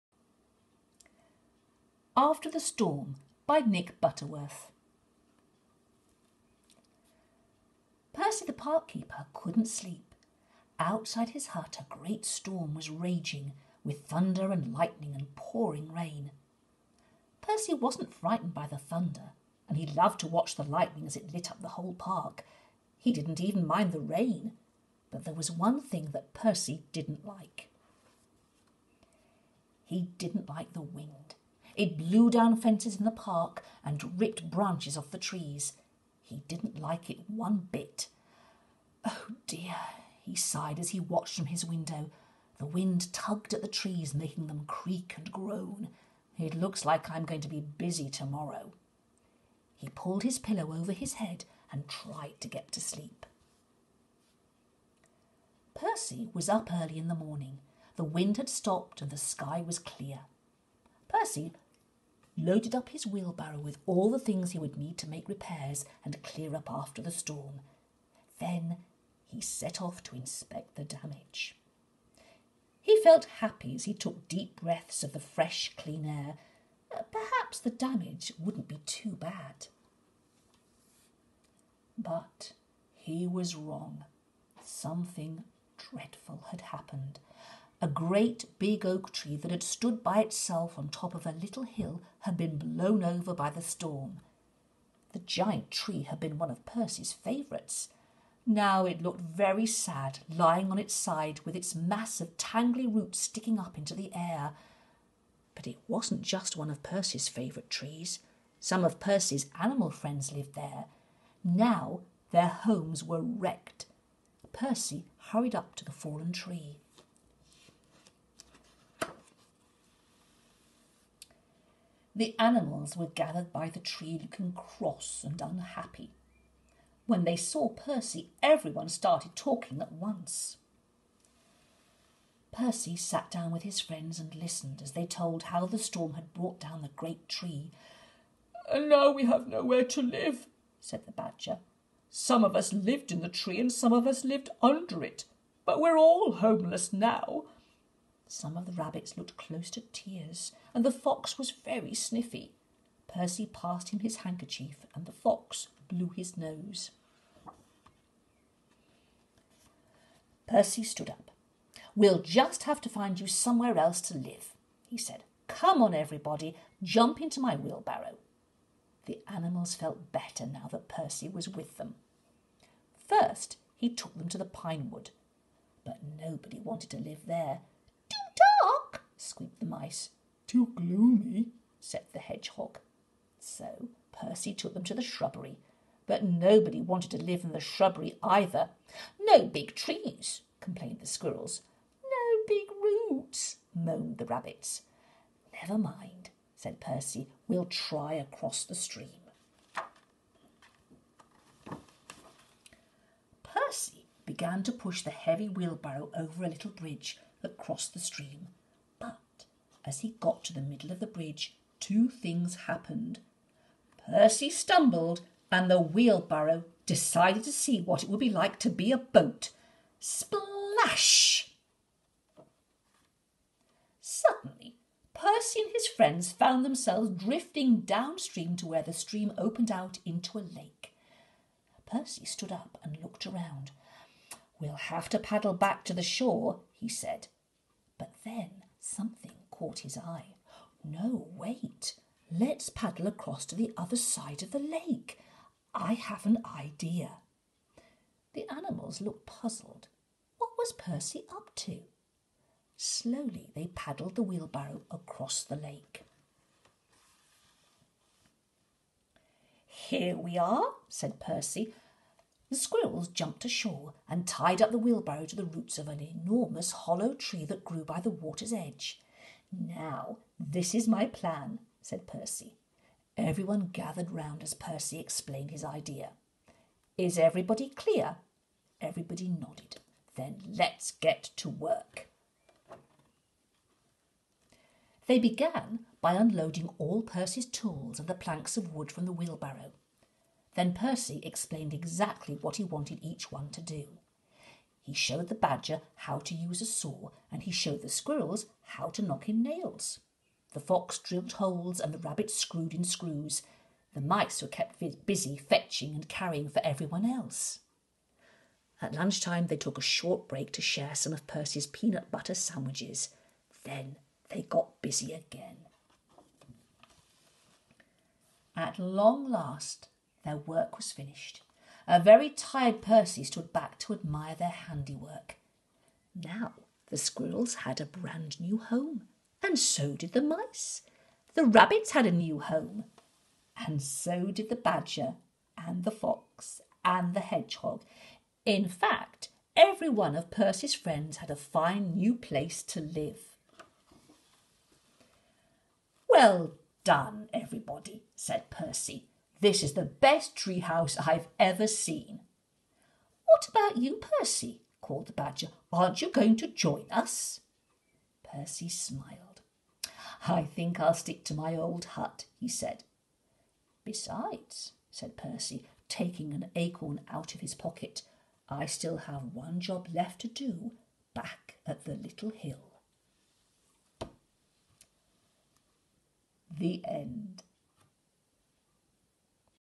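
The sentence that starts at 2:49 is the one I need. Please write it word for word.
The animals felt better now that Percy was with them.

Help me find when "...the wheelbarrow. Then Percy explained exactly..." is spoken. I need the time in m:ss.
4:49.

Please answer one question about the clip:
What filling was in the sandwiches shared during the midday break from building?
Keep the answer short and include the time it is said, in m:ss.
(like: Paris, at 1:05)
Peanut butter, at 5:11.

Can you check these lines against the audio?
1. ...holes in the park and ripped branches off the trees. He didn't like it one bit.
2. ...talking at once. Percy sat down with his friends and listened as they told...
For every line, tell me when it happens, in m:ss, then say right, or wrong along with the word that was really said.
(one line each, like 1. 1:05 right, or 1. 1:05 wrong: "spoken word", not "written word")
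1. 0:32 wrong: "fences", not "holes"
2. 2:09 right.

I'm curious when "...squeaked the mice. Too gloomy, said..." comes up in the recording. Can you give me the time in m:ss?
2:59.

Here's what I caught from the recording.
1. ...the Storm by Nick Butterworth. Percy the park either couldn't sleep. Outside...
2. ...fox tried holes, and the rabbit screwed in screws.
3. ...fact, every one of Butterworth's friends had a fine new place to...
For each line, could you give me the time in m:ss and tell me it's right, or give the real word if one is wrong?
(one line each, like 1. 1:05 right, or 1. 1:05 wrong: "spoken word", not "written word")
1. 0:02 wrong: "keeper", not "either"
2. 5:00 wrong: "drilled", not "tried"
3. 5:38 wrong: "Percy", not "Butterworth".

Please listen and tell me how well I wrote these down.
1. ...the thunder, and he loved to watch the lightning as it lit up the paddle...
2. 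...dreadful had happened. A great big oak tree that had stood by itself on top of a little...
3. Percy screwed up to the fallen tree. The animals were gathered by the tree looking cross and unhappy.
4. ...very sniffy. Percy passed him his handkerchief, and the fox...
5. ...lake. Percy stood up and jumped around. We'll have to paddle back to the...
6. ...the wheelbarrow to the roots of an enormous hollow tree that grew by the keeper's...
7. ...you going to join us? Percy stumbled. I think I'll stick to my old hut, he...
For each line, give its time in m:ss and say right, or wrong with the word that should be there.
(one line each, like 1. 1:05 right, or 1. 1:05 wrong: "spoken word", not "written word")
1. 0:18 wrong: "whole", not "paddle"
2. 1:25 right
3. 1:54 wrong: "hurried", not "screwed"
4. 2:31 right
5. 3:50 wrong: "looked", not "jumped"
6. 4:24 wrong: "water", not "keeper"
7. 5:56 wrong: "smiled", not "stumbled".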